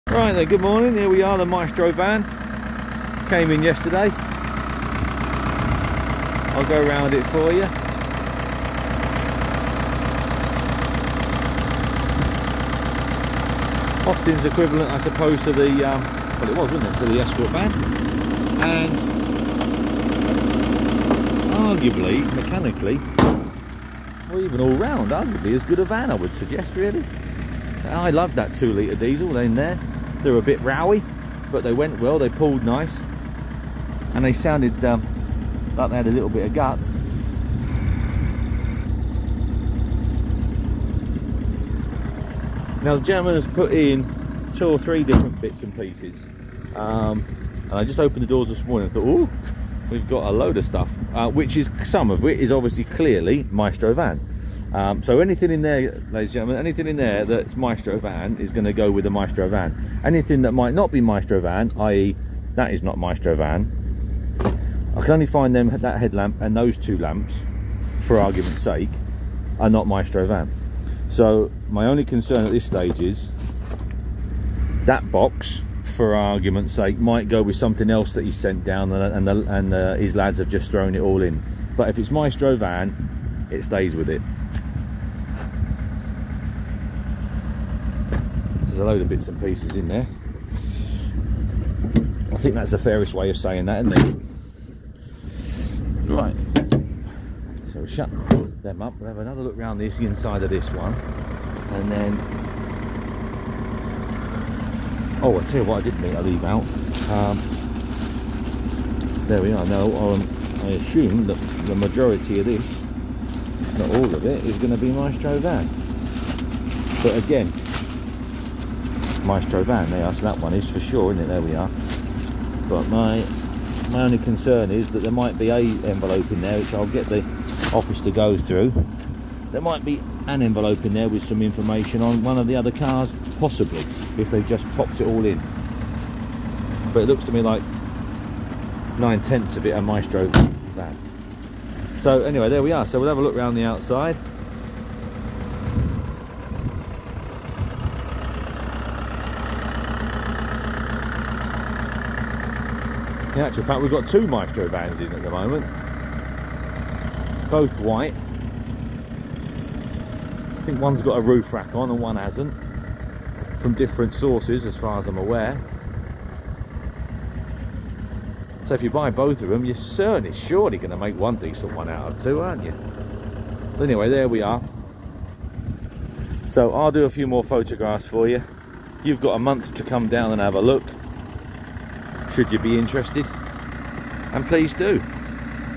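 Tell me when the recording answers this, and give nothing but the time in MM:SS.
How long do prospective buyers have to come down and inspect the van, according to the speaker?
02:59.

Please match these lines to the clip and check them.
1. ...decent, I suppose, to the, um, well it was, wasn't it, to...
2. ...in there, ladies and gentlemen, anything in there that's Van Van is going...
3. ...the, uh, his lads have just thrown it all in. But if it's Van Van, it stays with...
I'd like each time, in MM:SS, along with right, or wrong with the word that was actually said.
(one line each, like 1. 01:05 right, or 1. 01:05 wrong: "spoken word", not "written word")
1. 00:14 wrong: "equivalent", not "decent"
2. 00:55 wrong: "Maestro", not "Van"
3. 01:19 wrong: "Maestro", not "Van".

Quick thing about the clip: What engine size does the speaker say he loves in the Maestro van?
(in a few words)
2 litre diesel.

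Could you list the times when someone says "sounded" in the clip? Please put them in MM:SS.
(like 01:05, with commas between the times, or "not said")
00:34.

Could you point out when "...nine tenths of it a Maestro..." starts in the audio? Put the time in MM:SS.
02:18.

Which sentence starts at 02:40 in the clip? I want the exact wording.
I think one's got a roof rack on and one hasn't, from different sources as far as I'm aware.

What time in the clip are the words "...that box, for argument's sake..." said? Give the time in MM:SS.
01:14.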